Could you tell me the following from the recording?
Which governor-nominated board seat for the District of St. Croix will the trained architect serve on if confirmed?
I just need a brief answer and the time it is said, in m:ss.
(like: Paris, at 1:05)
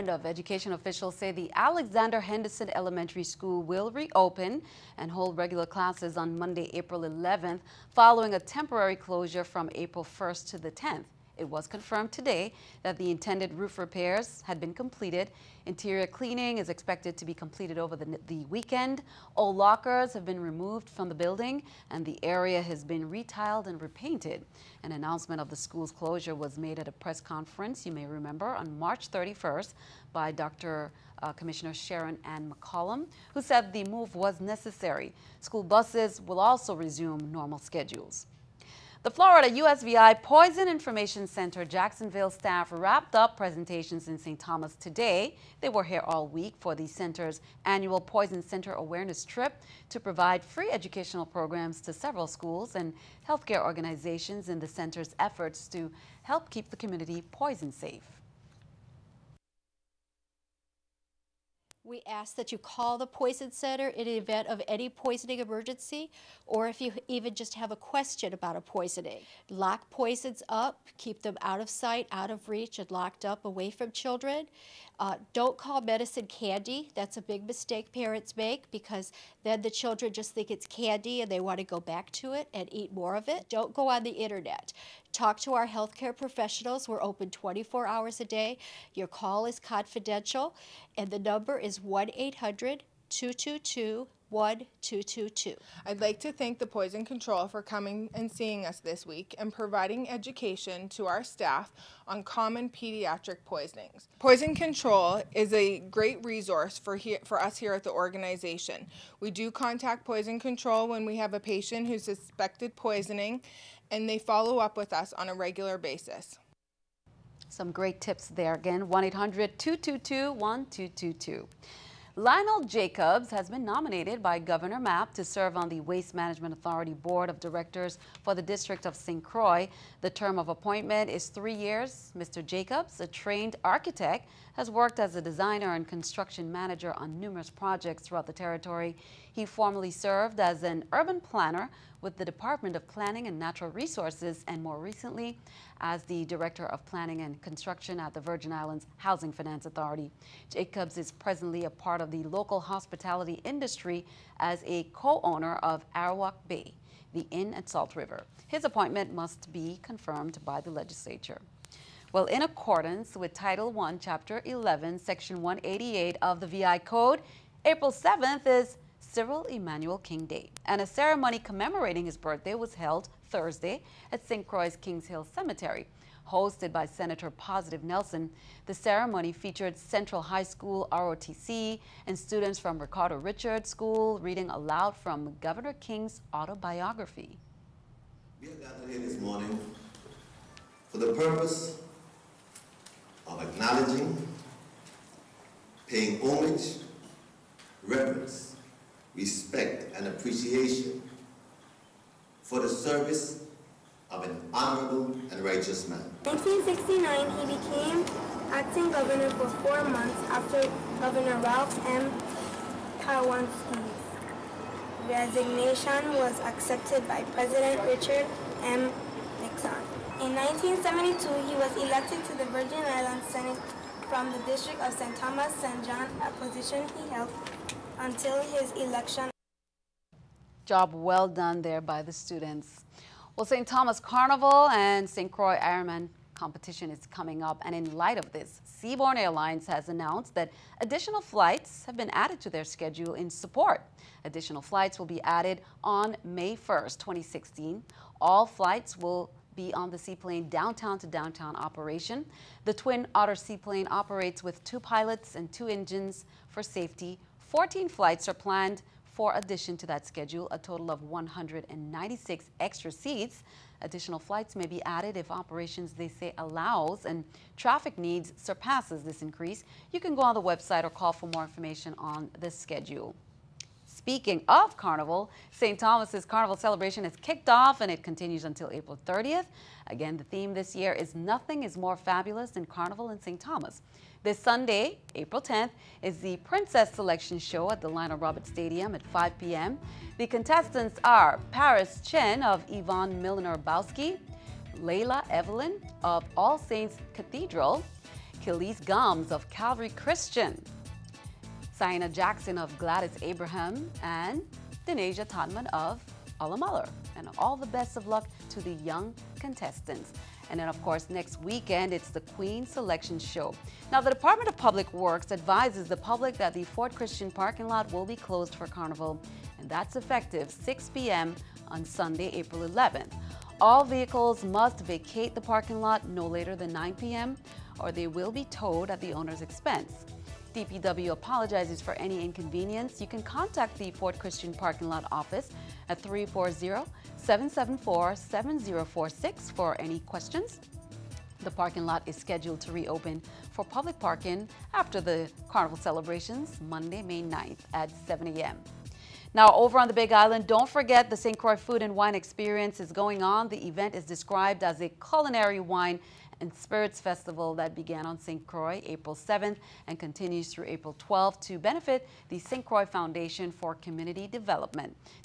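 Waste Management Authority Board, at 2:05.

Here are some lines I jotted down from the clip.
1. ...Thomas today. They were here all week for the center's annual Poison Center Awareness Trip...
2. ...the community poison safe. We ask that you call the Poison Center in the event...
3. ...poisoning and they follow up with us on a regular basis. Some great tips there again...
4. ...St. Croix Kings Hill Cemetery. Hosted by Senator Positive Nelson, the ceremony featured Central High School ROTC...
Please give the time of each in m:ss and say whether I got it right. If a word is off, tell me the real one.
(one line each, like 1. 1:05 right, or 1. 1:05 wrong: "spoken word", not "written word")
1. 0:44 right
2. 0:56 right
3. 1:52 right
4. 2:54 right.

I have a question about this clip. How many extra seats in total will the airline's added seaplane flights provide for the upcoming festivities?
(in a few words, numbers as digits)
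196.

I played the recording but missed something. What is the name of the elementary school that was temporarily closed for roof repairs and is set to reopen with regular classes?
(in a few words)
Alexander Henderson Elementary School.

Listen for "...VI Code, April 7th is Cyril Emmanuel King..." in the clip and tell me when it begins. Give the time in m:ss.
2:46.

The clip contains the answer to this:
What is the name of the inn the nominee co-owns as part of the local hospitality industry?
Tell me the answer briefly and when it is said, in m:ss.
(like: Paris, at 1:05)
Arawak Bay, at 2:35.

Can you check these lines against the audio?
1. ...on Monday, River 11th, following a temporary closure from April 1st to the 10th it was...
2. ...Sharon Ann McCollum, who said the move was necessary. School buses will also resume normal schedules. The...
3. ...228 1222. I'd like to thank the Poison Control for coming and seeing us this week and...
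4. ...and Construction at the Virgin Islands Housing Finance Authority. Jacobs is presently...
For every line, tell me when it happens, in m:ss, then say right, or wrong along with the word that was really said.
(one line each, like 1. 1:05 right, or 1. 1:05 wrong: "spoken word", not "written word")
1. 0:06 wrong: "April", not "River"
2. 0:31 right
3. 1:33 wrong: "222", not "228"
4. 2:27 right.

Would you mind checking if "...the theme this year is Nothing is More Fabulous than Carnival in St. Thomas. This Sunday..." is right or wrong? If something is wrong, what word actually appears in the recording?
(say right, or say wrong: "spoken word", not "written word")
right.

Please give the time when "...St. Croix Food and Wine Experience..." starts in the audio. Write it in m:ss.
5:51.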